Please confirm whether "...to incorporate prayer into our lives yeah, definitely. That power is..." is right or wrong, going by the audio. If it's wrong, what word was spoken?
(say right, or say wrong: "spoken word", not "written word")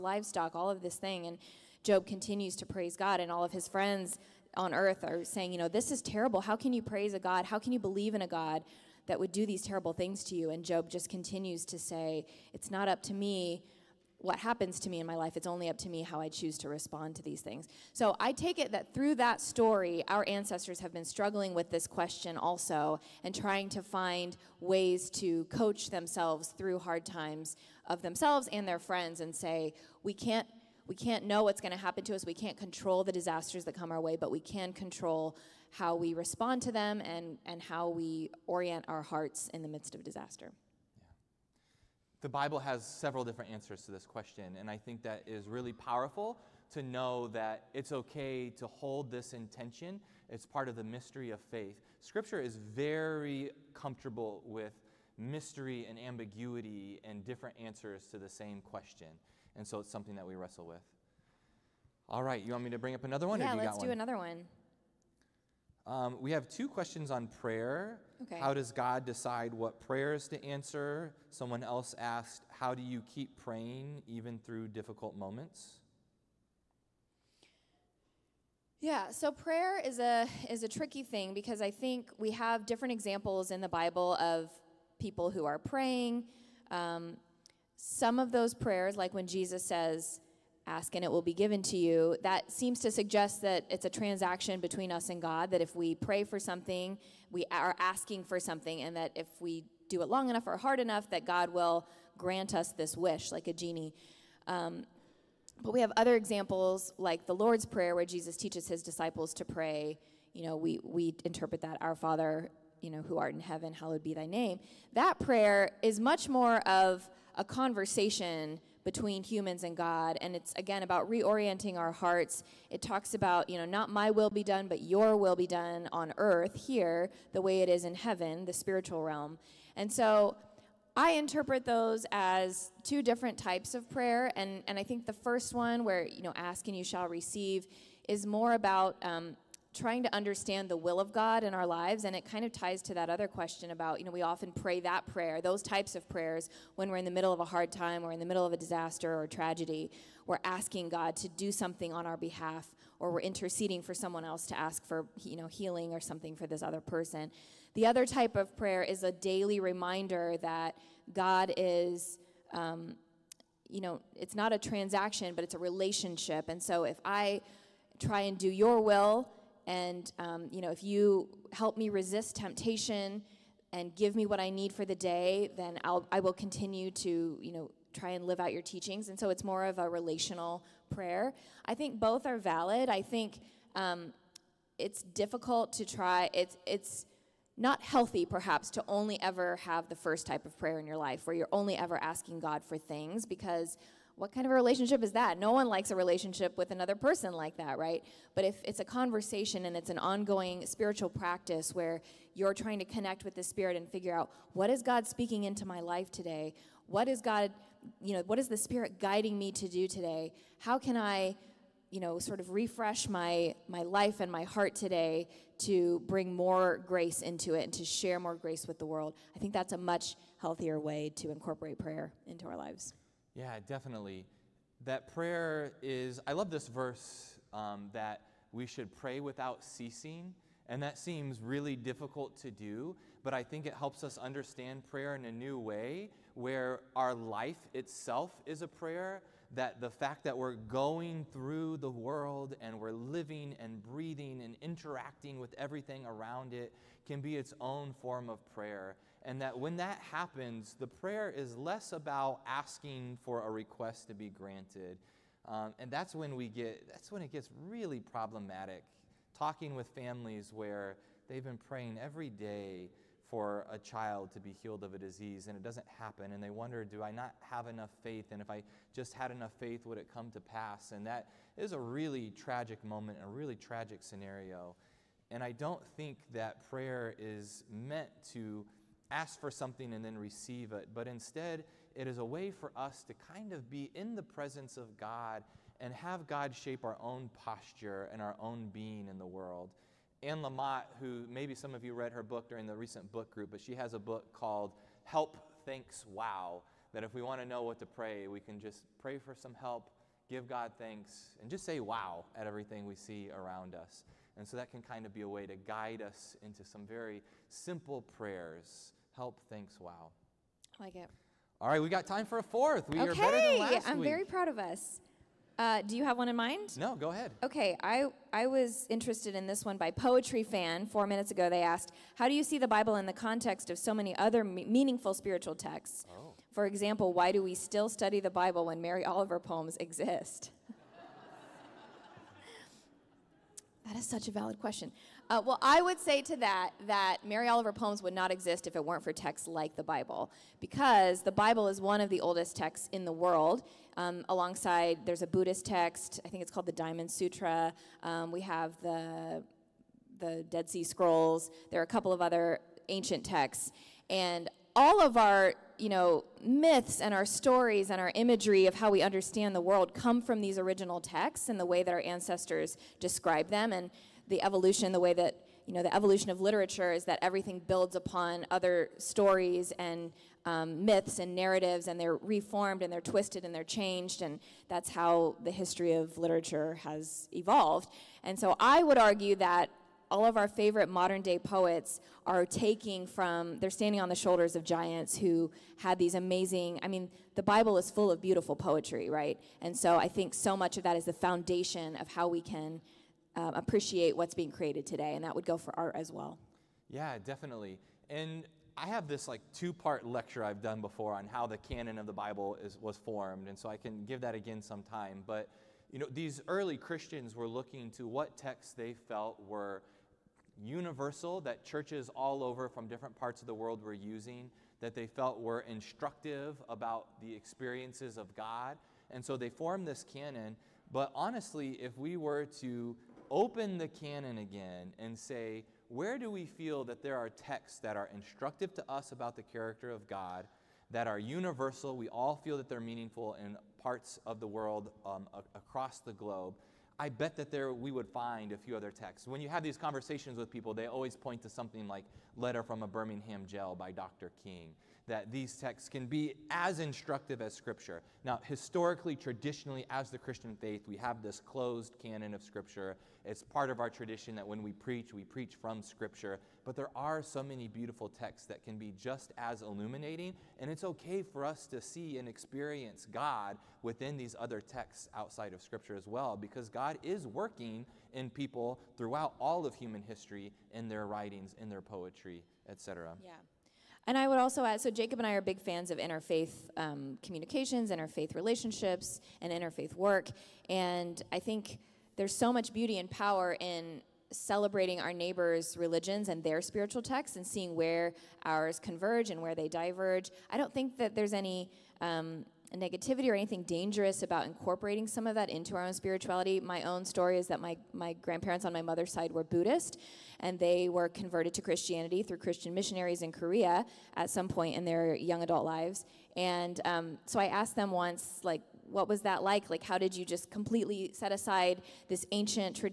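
wrong: "prayer", not "power".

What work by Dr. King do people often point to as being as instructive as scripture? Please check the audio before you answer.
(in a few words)
Letter from a Birmingham Jail.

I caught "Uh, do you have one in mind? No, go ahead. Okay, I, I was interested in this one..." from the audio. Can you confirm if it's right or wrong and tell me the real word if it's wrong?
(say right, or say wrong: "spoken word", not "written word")
right.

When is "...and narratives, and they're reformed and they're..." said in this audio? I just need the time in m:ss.
6:11.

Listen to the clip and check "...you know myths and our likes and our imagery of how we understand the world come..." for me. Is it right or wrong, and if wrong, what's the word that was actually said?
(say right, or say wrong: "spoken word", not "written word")
wrong: "stories", not "likes".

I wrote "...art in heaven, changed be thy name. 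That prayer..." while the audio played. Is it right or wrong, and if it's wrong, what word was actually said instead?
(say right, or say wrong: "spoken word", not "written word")
wrong: "hallowed", not "changed".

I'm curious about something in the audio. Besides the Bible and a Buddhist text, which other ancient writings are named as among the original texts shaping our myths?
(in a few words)
The Dead Sea Scrolls.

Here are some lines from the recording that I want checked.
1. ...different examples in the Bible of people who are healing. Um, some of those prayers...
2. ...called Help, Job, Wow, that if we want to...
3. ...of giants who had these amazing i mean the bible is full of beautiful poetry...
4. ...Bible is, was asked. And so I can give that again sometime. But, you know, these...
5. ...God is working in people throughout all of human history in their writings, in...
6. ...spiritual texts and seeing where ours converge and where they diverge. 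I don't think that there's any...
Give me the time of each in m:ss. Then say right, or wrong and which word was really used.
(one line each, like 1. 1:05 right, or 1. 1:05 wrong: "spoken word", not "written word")
1. 1:22 wrong: "praying", not "healing"
2. 4:54 wrong: "Thanks", not "Job"
3. 6:24 right
4. 6:42 wrong: "formed", not "asked"
5. 7:46 right
6. 8:06 right.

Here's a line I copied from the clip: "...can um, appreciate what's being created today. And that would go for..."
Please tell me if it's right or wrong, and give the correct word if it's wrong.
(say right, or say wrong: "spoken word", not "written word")
right.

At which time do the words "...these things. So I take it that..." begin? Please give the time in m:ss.
0:17.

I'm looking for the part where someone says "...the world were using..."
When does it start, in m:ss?
6:53.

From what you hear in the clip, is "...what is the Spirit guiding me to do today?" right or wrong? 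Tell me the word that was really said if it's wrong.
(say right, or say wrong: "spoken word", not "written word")
right.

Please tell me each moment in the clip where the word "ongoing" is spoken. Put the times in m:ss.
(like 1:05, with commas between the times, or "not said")
3:19.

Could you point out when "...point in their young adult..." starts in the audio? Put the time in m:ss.
8:24.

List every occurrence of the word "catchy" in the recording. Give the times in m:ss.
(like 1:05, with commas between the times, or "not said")
not said.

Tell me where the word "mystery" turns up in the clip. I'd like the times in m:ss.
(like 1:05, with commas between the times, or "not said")
0:50, 0:55.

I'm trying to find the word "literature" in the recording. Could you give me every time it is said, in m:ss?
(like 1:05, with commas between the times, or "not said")
6:06, 6:16.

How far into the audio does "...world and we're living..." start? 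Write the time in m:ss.
4:01.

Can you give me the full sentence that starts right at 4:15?
Um, and that's when we get, that's when it gets really problematic.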